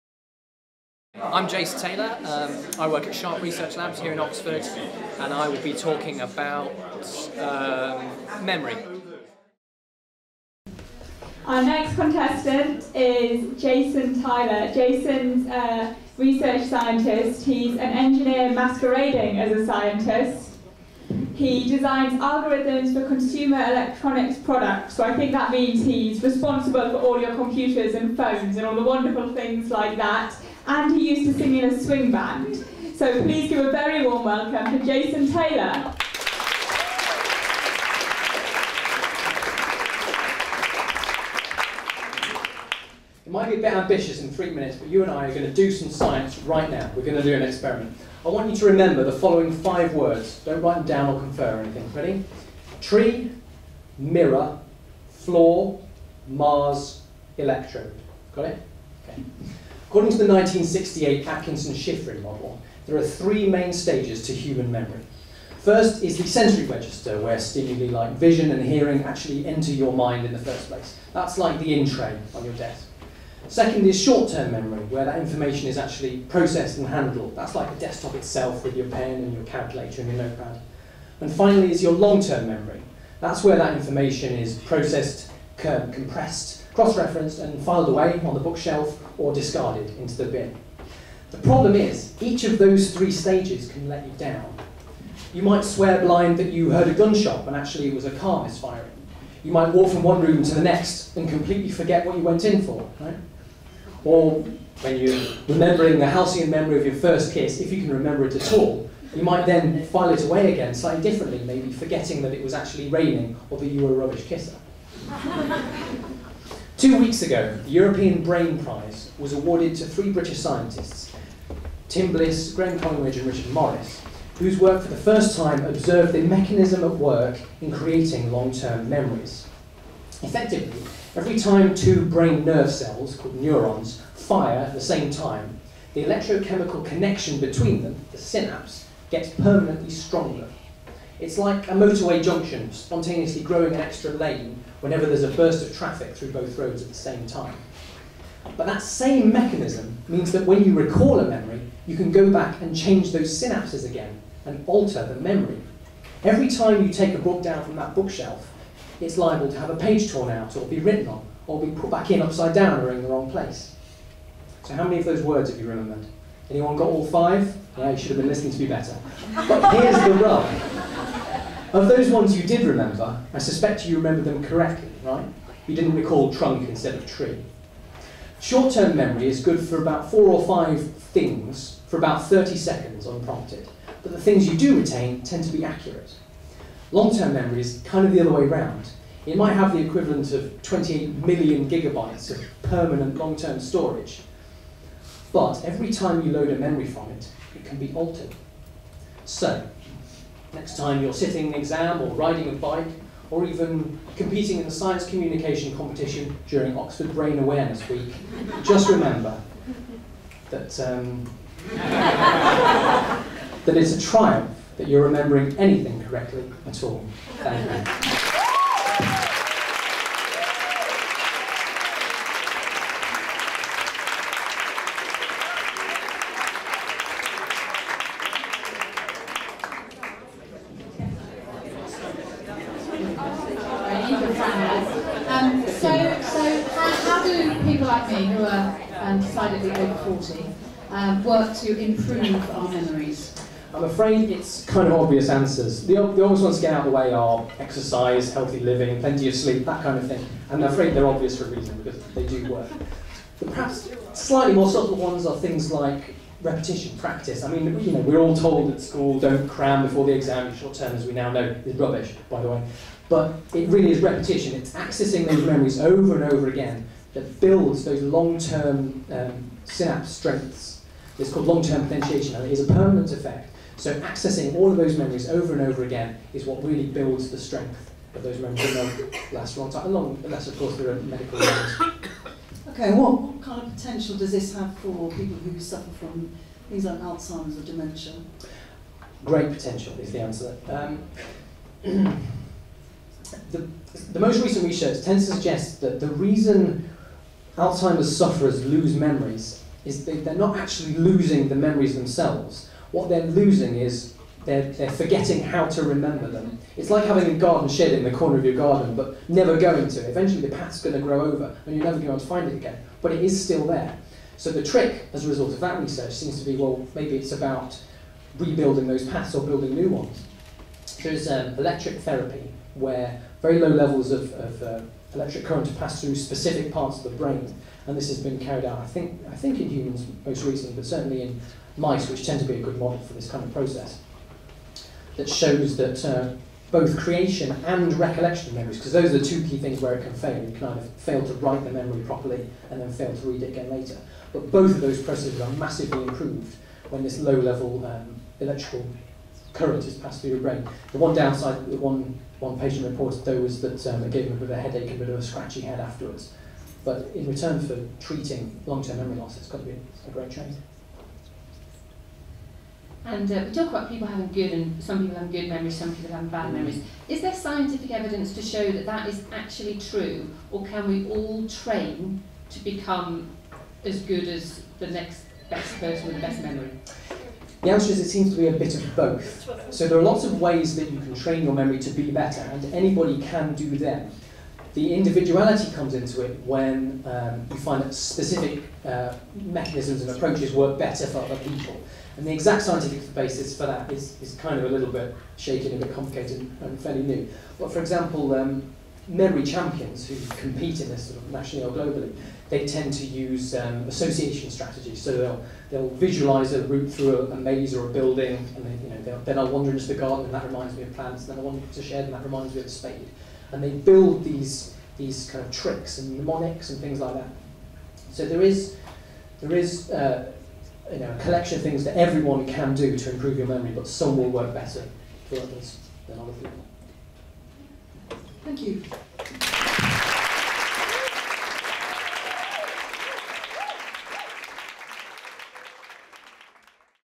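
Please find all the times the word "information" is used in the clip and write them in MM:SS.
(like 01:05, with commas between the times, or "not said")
01:15, 01:23.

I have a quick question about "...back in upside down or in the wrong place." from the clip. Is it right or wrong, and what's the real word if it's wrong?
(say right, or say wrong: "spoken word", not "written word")
right.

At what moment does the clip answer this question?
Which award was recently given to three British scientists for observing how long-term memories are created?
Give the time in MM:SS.
01:57.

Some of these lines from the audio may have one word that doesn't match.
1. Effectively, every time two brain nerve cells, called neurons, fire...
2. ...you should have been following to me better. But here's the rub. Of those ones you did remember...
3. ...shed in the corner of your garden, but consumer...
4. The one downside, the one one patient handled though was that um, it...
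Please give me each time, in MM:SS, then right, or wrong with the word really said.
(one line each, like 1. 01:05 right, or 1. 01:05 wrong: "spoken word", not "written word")
1. 02:10 right
2. 02:47 wrong: "listening", not "following"
3. 05:07 wrong: "never", not "consumer"
4. 05:50 wrong: "reported", not "handled".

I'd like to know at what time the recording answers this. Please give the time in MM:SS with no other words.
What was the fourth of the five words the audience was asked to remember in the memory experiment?
00:56.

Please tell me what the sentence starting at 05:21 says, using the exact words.
There's um, electric therapy, where very low levels of, of uh, electric current to pass through specific parts of the brain.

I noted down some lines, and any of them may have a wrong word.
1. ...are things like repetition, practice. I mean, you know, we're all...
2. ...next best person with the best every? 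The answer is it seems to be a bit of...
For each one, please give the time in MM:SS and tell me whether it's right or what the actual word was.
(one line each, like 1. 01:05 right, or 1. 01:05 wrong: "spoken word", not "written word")
1. 04:15 right
2. 06:14 wrong: "memory", not "every".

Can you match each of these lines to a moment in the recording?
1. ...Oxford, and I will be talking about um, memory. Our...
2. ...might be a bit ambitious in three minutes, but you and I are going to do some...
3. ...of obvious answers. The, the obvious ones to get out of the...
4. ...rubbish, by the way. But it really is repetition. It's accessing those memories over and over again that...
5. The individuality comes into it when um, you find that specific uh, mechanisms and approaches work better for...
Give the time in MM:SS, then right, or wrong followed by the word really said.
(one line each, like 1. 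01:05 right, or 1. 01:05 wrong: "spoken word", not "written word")
1. 00:04 right
2. 00:43 right
3. 04:04 right
4. 04:21 right
5. 06:24 right.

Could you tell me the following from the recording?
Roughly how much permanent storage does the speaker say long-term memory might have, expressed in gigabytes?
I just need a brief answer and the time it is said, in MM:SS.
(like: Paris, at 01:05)
28 million gigabytes, at 03:10.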